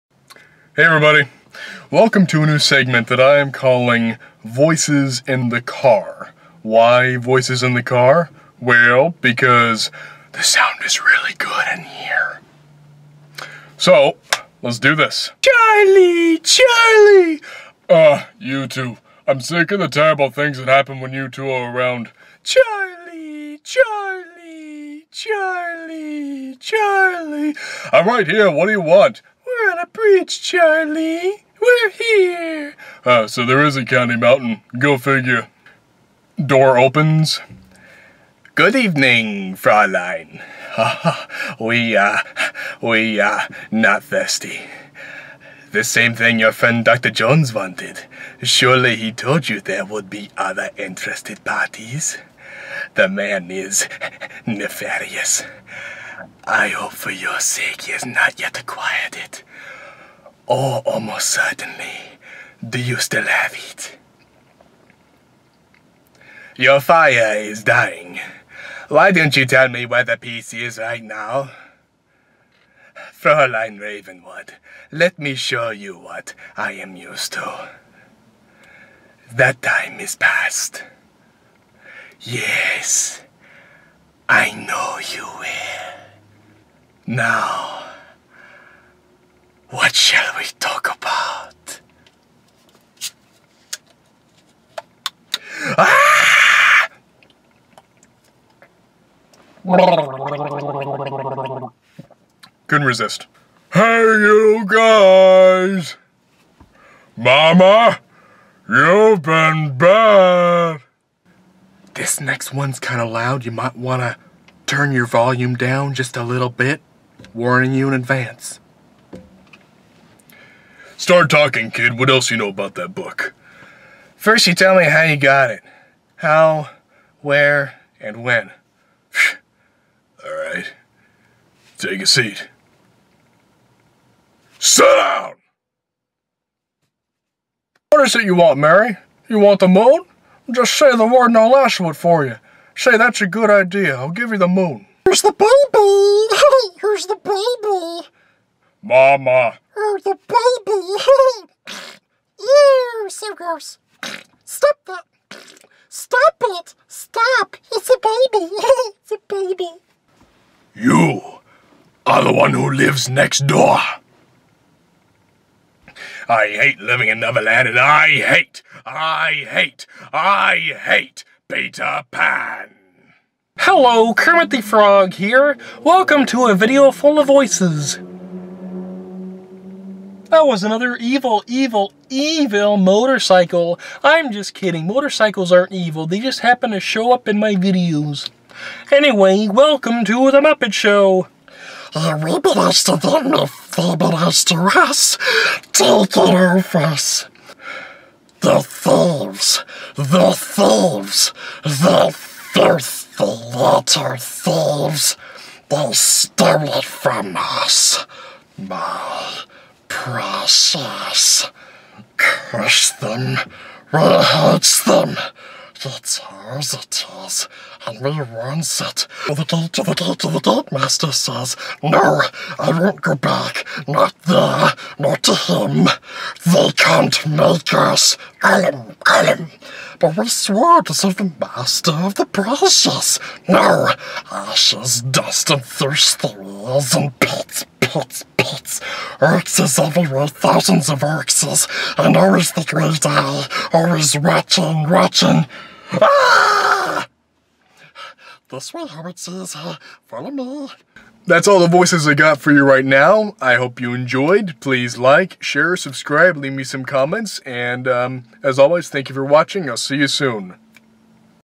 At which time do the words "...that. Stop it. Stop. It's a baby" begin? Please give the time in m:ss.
2:34.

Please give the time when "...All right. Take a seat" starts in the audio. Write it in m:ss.
2:10.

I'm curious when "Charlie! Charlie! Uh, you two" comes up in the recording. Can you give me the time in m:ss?
0:15.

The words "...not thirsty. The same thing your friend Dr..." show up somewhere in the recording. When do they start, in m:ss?
0:43.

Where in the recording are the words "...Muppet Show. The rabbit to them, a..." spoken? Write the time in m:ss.
3:10.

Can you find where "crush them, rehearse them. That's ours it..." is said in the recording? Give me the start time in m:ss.
3:32.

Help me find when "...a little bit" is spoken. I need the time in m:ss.
1:56.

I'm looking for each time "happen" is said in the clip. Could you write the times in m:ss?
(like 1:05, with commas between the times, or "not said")
0:20, 3:06.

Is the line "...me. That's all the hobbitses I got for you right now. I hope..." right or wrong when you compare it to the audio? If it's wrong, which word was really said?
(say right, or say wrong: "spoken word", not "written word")
wrong: "voices", not "hobbitses".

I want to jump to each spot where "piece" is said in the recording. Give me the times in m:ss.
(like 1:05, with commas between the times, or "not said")
1:10.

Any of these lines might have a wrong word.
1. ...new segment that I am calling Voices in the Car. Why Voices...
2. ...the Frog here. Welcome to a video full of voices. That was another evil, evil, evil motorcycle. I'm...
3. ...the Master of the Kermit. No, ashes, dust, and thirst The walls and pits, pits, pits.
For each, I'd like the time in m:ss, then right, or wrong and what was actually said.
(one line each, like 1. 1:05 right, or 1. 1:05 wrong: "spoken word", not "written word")
1. 0:02 right
2. 2:54 right
3. 3:51 wrong: "Precious", not "Kermit".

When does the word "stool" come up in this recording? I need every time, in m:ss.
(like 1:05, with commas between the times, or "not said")
not said.